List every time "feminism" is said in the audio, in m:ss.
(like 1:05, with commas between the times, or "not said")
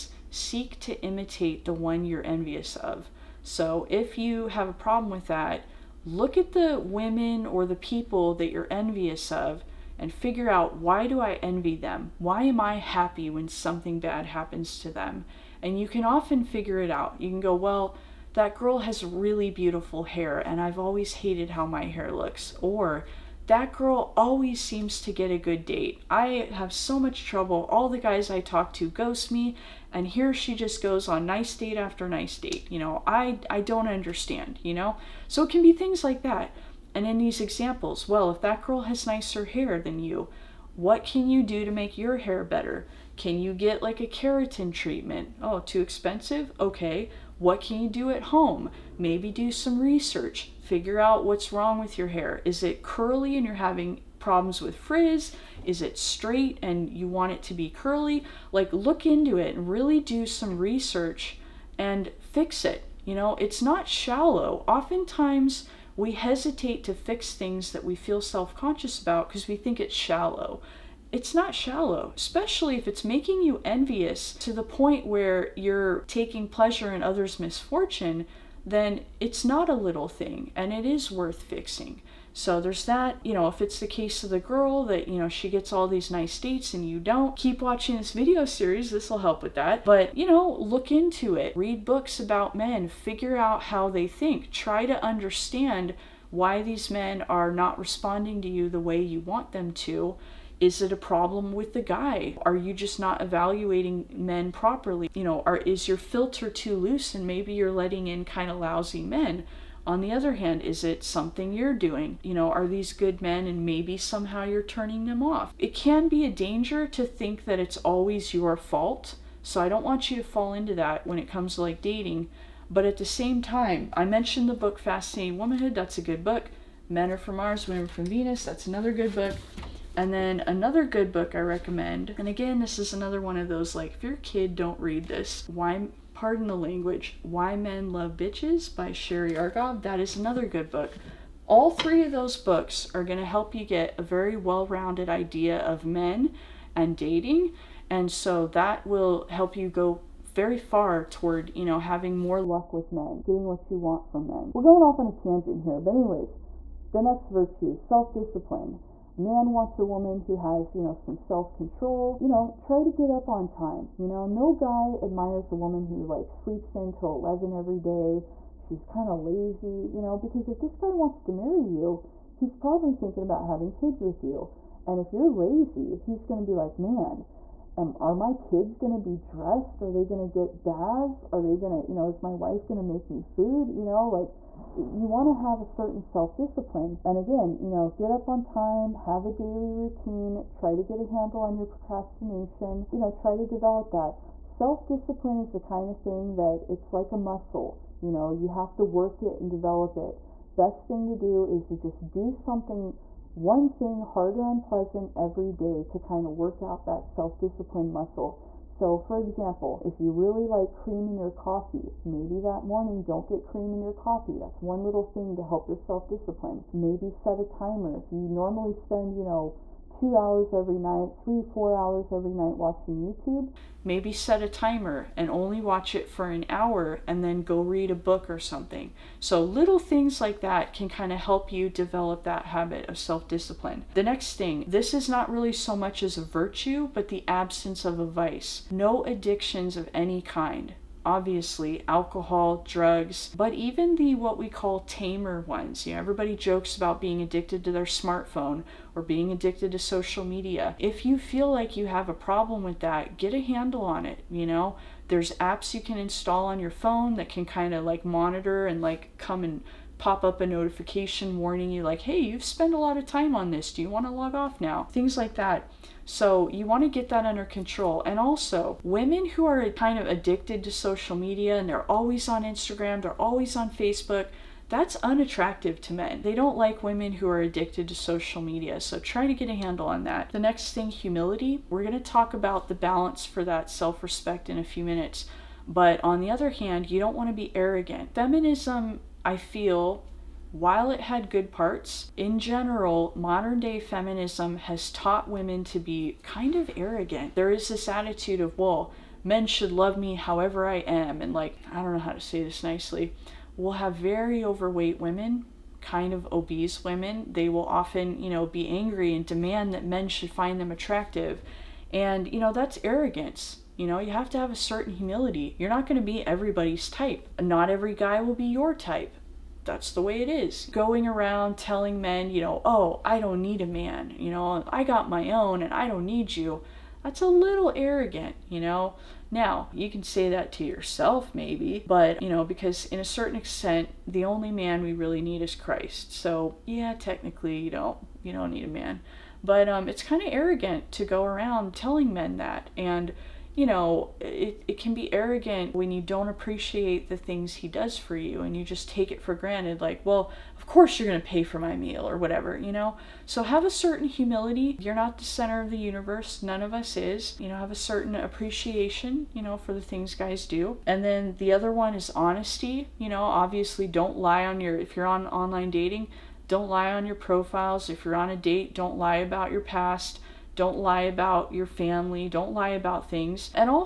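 4:48, 4:53.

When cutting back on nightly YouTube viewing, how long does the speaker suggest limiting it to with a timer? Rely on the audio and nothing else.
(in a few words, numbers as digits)
an hour.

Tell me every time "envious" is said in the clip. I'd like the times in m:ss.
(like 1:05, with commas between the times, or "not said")
0:02, 0:08, 1:13.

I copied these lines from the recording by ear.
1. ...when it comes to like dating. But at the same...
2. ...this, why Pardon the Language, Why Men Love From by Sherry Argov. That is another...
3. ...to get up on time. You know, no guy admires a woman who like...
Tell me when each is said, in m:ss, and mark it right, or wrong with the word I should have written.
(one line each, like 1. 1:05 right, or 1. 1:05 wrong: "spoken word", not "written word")
1. 2:01 right
2. 2:15 wrong: "Bitches", not "From"
3. 2:42 right.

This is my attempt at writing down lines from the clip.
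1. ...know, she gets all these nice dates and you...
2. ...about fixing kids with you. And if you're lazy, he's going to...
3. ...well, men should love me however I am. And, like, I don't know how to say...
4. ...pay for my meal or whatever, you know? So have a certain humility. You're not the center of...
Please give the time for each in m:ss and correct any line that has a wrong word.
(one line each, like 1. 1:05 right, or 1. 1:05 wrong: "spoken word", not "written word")
1. 1:25 right
2. 2:53 wrong: "having", not "fixing"
3. 4:58 right
4. 5:51 right.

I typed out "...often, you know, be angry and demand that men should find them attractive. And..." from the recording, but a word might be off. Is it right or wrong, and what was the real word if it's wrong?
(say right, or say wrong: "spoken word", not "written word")
right.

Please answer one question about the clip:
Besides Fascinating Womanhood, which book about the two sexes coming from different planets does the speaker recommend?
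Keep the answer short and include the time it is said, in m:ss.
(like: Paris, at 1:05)
Men Are From Mars, Women From Venus, at 2:06.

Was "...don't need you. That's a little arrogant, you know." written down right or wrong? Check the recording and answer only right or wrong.
right.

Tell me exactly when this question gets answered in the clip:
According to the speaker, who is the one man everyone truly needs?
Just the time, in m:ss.
5:35.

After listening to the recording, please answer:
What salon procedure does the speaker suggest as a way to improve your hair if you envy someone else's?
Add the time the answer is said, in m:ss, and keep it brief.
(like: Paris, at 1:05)
keratin treatment, at 0:44.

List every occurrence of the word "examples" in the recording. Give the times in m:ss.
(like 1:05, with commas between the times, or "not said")
0:37, 3:29.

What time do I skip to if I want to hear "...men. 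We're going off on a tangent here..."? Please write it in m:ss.
2:34.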